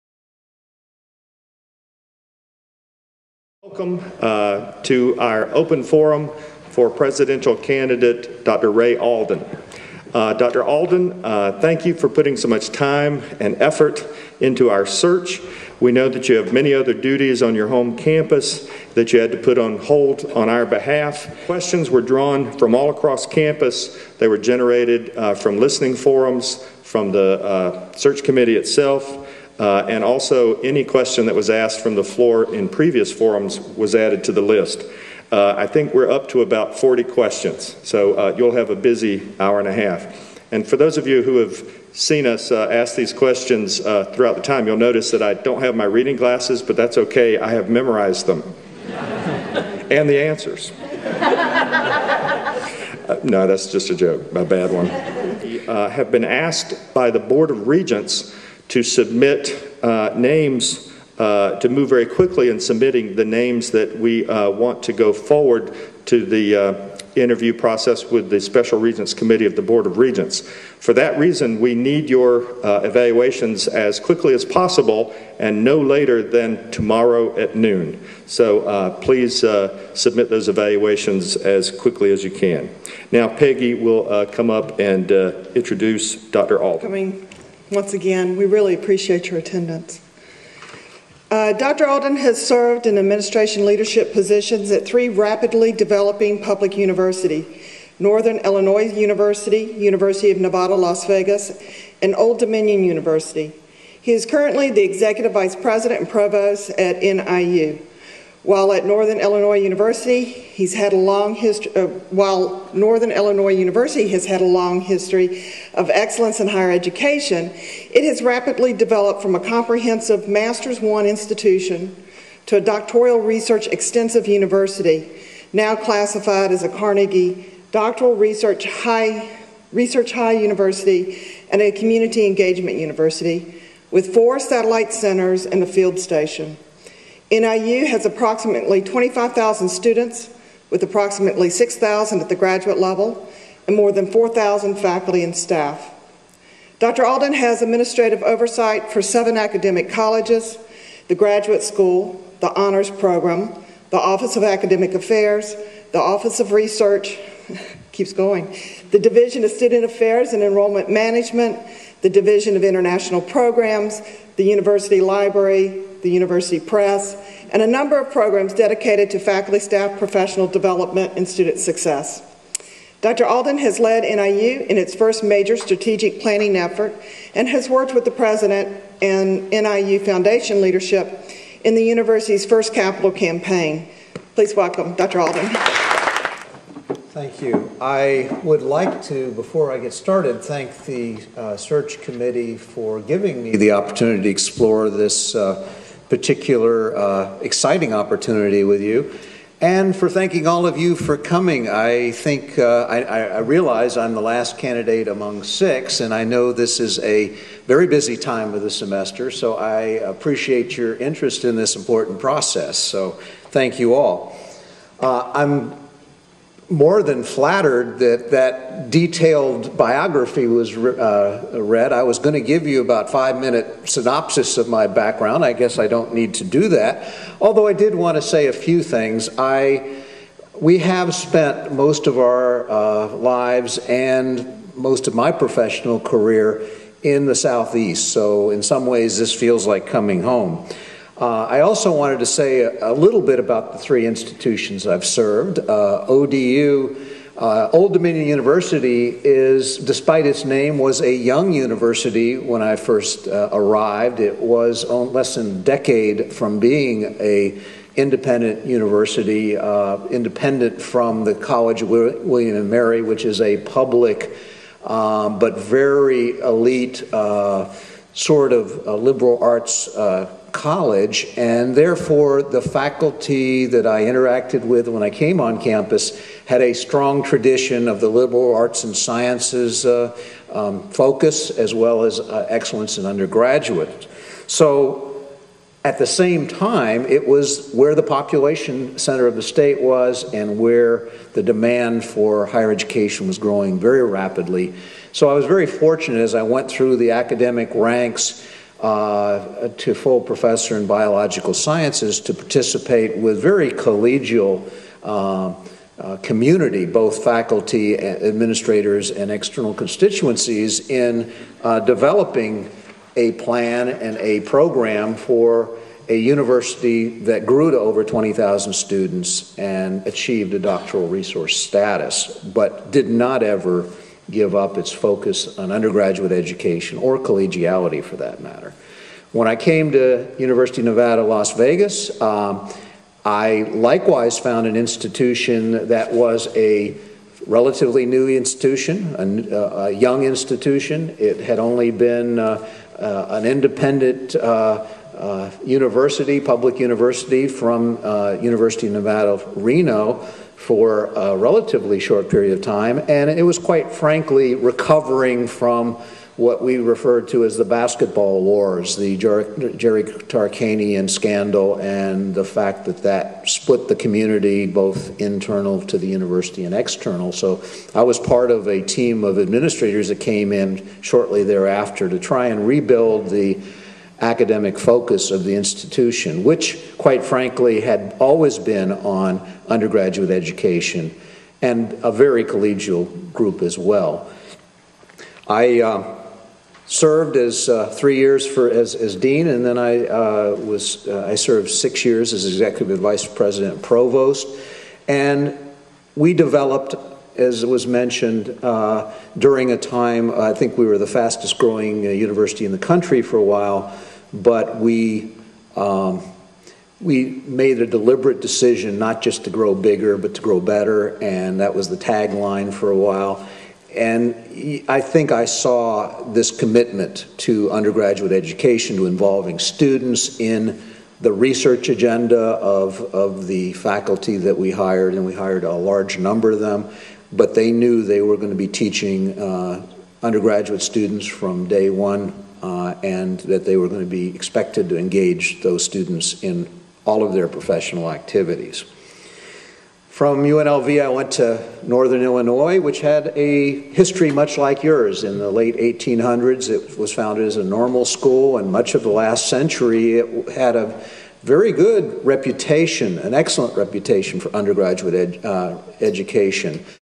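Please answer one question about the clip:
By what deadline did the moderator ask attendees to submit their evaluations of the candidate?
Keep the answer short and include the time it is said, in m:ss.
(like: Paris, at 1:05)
tomorrow at noon, at 1:16.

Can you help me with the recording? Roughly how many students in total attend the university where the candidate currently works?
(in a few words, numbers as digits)
25,000.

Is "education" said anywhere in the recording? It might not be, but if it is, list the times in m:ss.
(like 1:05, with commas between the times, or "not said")
1:56, 4:52, 5:26, 6:20, 6:58, 7:36.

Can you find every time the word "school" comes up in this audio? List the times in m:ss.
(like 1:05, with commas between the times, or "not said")
2:31, 7:28.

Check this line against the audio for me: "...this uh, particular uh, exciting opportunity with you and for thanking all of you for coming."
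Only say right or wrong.
right.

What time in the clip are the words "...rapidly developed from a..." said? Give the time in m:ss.
1:58.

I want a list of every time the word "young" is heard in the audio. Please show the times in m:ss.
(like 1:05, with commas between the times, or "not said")
4:11, 5:39.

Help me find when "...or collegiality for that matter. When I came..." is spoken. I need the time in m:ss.
5:26.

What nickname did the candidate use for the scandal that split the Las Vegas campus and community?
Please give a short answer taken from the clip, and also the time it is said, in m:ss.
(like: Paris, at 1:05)
the basketball wars, at 5:57.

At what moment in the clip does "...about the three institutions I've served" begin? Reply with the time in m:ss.
4:03.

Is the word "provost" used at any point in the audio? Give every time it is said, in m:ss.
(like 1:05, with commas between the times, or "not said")
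1:46, 6:33.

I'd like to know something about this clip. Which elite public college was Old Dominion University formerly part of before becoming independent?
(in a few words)
College of William and Mary.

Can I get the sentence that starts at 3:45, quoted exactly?
I guess I don't need to do that.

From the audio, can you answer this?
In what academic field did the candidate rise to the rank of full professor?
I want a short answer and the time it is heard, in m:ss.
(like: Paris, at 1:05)
biological sciences, at 5:00.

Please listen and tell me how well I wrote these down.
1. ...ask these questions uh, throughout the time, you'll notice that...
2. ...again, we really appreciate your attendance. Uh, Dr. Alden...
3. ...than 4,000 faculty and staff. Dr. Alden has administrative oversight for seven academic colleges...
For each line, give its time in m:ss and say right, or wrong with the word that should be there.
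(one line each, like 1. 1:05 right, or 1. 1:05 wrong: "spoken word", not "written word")
1. 0:42 right
2. 1:27 right
3. 2:23 right.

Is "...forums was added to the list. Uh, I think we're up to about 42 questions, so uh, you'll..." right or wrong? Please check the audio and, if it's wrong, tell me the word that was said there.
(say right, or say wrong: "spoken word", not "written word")
wrong: "40", not "42".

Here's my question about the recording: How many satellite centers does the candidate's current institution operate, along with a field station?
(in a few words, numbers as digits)
4.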